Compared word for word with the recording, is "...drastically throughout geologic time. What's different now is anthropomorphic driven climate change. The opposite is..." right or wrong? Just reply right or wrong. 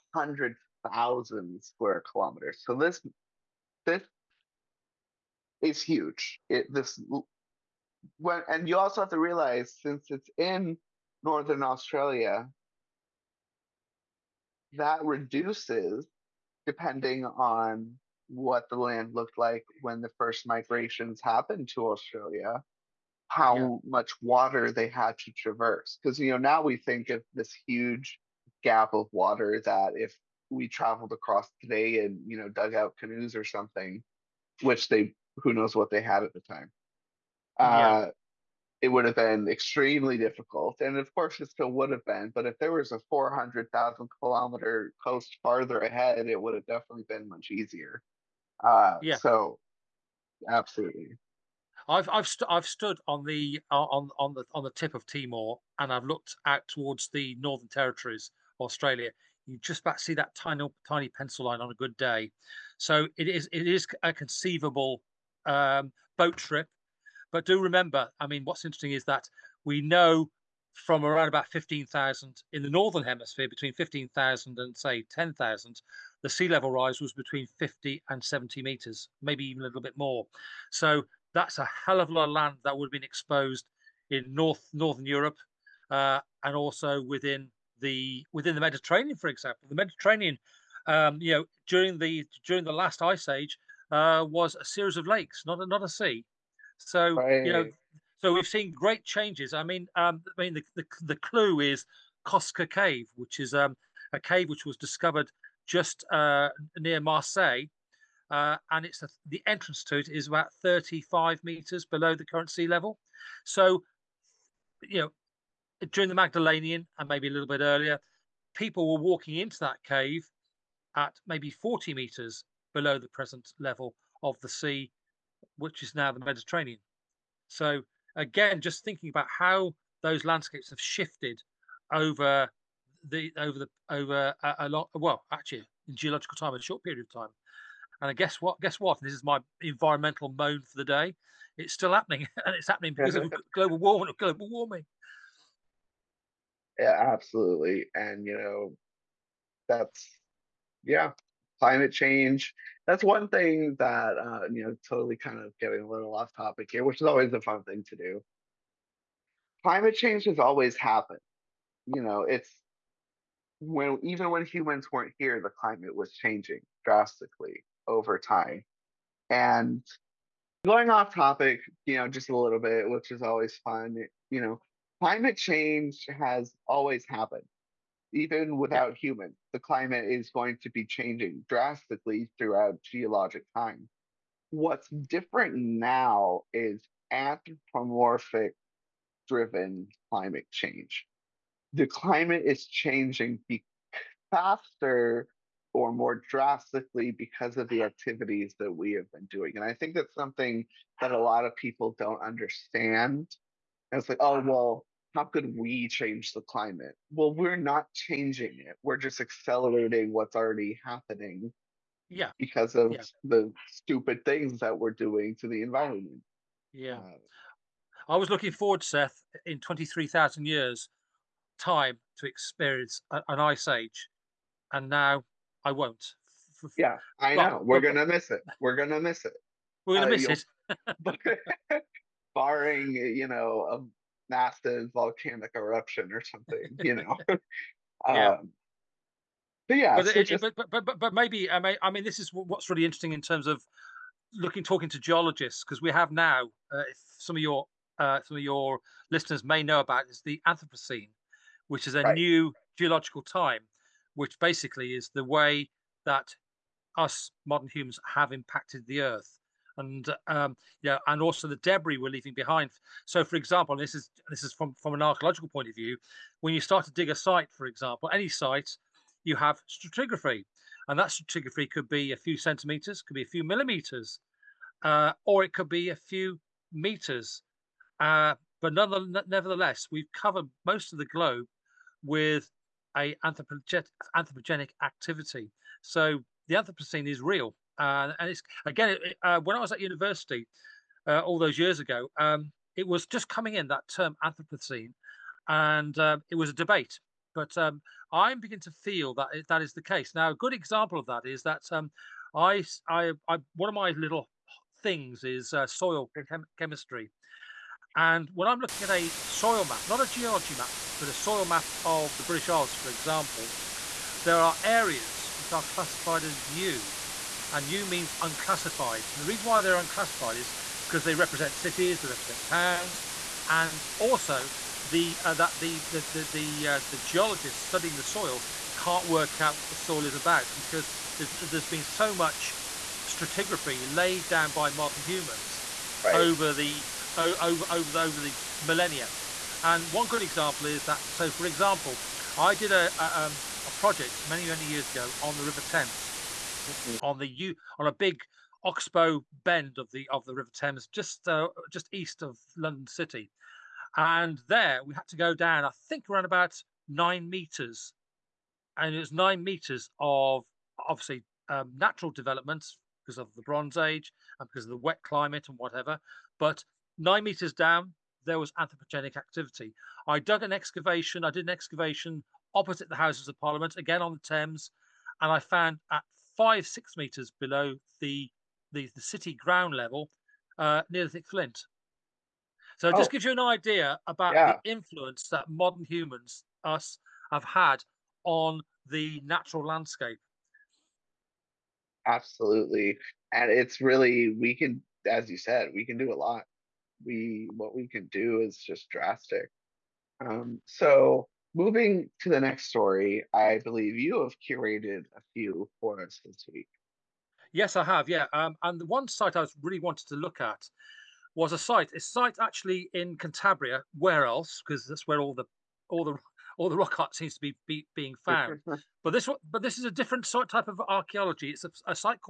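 wrong.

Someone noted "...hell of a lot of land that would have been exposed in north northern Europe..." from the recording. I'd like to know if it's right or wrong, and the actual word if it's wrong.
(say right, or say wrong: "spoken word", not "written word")
right.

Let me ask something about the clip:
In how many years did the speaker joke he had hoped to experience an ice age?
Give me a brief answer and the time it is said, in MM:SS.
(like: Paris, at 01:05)
23,000, at 03:39.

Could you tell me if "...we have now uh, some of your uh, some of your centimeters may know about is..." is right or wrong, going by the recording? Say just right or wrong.
wrong.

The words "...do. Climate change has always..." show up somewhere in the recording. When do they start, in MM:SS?
02:37.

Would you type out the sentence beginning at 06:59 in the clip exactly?
but this one, but this is a different sort, type of archaeology.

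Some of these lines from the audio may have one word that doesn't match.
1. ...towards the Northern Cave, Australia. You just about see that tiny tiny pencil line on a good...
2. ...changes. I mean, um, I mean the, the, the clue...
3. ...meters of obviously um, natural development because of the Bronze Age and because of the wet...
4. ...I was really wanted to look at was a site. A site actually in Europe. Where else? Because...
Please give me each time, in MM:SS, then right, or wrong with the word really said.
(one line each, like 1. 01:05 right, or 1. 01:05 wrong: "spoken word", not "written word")
1. 00:56 wrong: "Territories", not "Cave"
2. 01:39 right
3. 05:59 right
4. 06:49 wrong: "Cantabria", not "Europe".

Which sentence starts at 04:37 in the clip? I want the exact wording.
Uh, but nevertheless, we've covered most of the globe with a anthropogenic, anthropogenic activity.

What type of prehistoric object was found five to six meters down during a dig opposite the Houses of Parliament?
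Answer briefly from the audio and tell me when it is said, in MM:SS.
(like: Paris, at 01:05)
Neolithic flint, at 06:20.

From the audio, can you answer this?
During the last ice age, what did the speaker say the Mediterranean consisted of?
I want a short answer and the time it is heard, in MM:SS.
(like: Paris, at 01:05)
a series of lakes, at 01:34.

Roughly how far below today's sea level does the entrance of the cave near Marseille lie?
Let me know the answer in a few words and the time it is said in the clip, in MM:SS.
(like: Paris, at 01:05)
35 meters, at 01:50.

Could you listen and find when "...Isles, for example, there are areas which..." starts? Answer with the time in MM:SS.
05:12.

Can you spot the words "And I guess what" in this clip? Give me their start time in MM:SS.
02:18.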